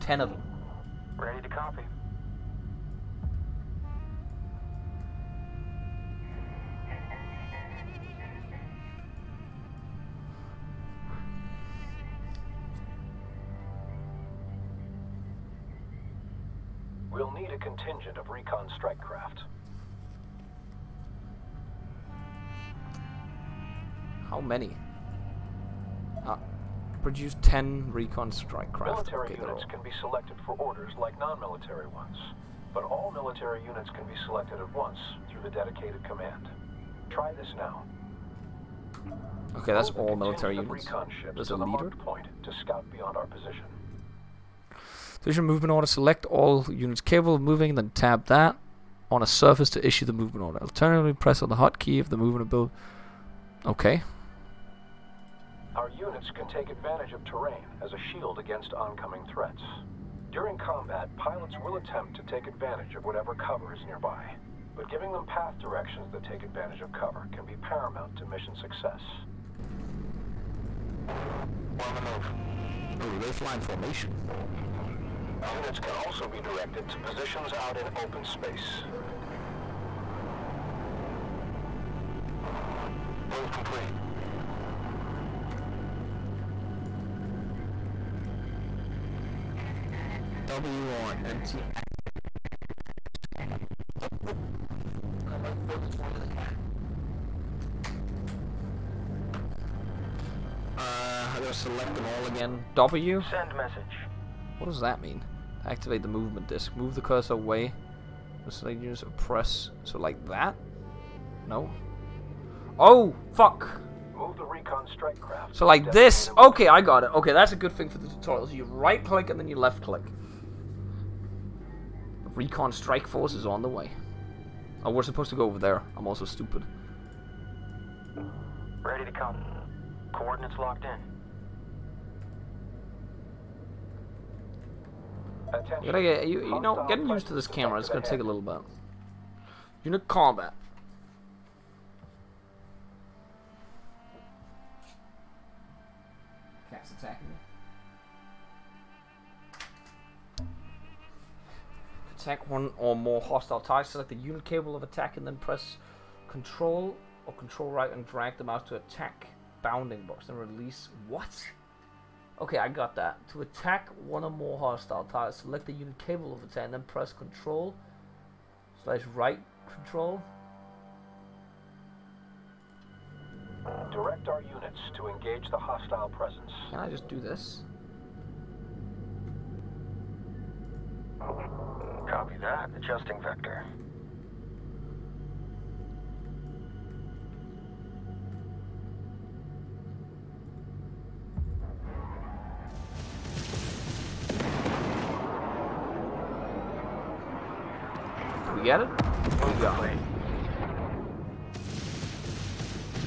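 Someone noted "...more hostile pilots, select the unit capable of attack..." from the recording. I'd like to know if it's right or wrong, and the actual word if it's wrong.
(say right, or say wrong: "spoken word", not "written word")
wrong: "targets", not "pilots".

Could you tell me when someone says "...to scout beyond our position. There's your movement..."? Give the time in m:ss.
0:42.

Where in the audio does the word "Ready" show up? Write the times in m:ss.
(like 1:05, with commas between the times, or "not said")
0:01, 2:08.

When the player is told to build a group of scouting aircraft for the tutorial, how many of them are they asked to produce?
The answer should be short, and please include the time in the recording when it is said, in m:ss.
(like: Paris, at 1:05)
10, at 0:27.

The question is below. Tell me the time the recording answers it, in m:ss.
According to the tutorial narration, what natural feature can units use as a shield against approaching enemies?
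0:57.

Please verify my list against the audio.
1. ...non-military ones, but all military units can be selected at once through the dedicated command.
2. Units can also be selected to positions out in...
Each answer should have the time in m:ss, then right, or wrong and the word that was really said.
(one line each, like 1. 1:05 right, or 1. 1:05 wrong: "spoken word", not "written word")
1. 0:31 right
2. 1:15 wrong: "directed", not "selected".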